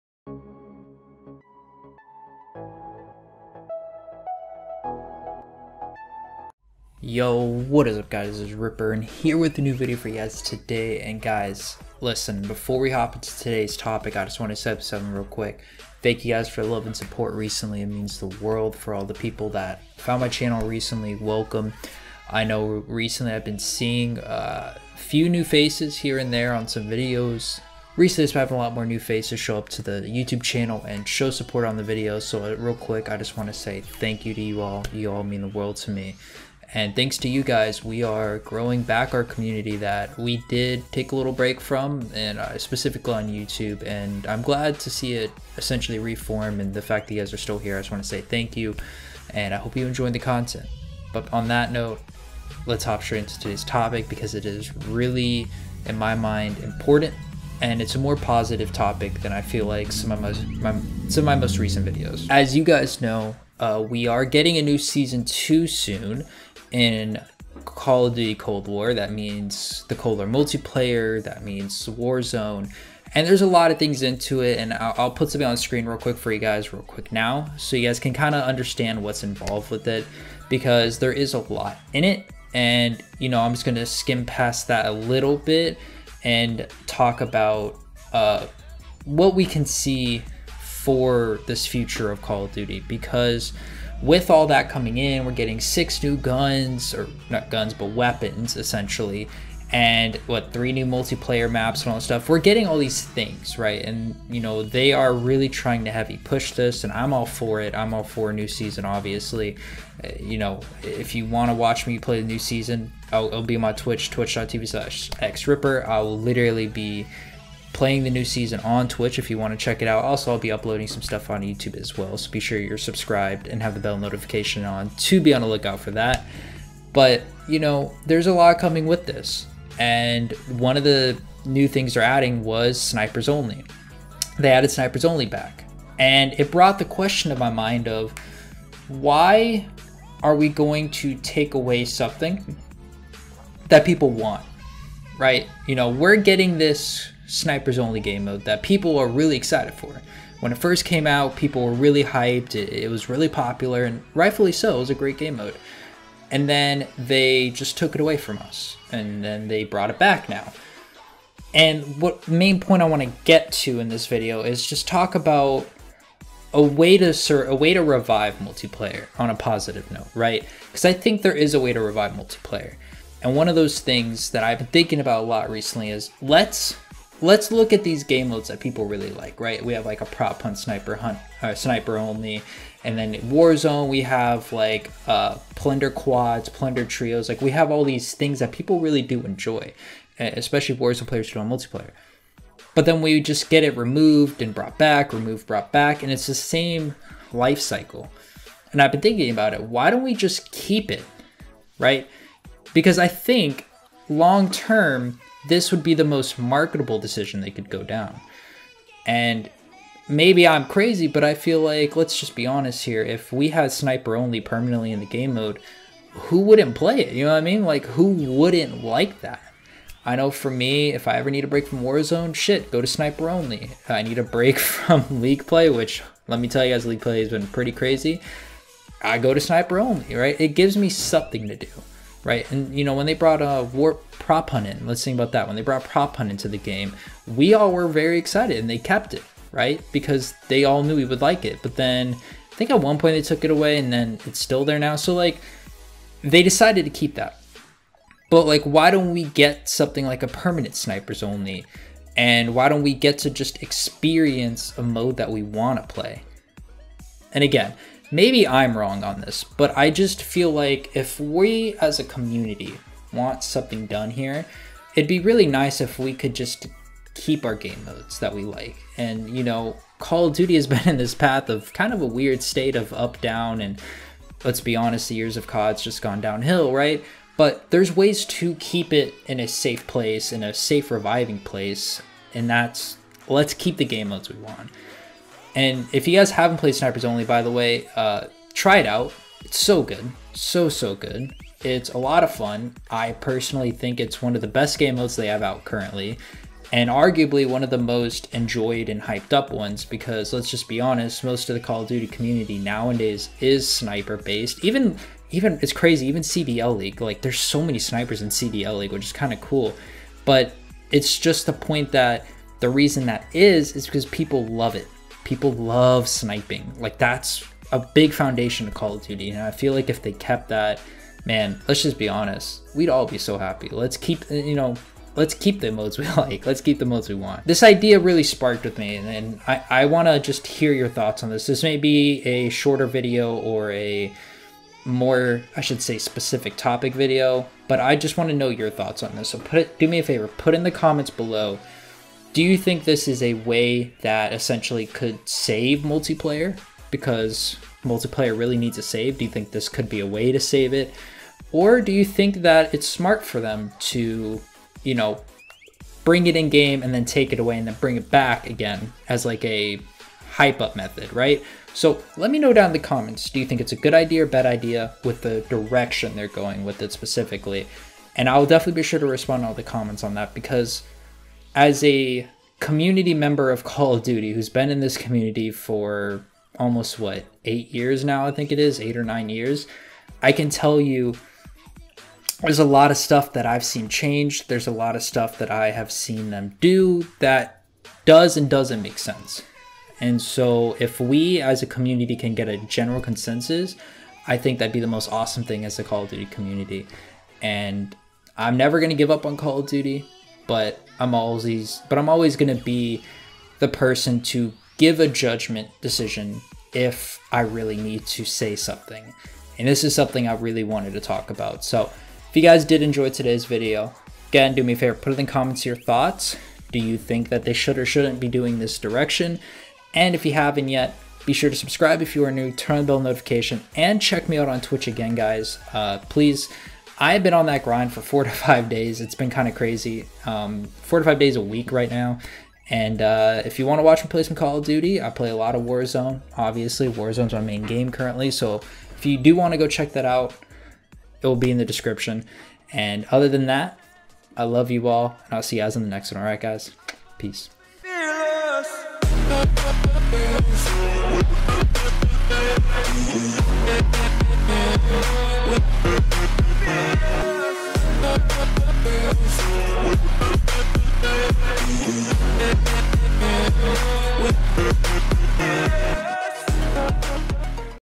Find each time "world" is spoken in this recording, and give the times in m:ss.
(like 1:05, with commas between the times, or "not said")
0:18, 0:35.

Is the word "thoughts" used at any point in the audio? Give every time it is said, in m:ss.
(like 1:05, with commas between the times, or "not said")
5:30, 5:38, 6:55.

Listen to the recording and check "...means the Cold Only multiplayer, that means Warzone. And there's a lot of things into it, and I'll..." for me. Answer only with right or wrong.
wrong.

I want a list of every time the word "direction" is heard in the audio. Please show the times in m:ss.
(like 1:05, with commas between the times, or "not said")
6:05, 6:58.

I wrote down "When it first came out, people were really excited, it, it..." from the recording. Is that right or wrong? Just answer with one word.
wrong.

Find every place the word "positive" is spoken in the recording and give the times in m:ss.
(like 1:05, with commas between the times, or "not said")
0:58, 2:49.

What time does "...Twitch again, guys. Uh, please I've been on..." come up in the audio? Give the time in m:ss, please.
7:04.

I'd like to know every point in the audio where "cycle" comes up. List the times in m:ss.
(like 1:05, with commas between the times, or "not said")
3:17.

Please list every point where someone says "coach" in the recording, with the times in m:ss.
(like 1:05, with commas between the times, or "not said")
not said.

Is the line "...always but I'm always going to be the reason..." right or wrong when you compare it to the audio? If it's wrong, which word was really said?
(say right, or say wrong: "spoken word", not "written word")
wrong: "person", not "reason".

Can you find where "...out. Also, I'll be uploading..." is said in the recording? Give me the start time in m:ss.
1:59.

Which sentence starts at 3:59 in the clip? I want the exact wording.
Because they all knew we would like it.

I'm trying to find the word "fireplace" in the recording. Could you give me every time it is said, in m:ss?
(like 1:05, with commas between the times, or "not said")
not said.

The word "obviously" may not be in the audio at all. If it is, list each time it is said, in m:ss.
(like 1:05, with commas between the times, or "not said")
1:48, 7:16.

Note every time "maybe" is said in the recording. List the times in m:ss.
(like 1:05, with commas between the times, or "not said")
3:30, 4:18.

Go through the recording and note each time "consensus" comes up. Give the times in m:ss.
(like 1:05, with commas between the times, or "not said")
6:32.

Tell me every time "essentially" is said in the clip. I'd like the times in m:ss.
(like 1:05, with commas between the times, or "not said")
0:45, 1:38, 5:44.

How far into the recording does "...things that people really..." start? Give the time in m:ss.
3:08.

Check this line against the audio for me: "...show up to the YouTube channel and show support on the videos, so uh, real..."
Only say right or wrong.
right.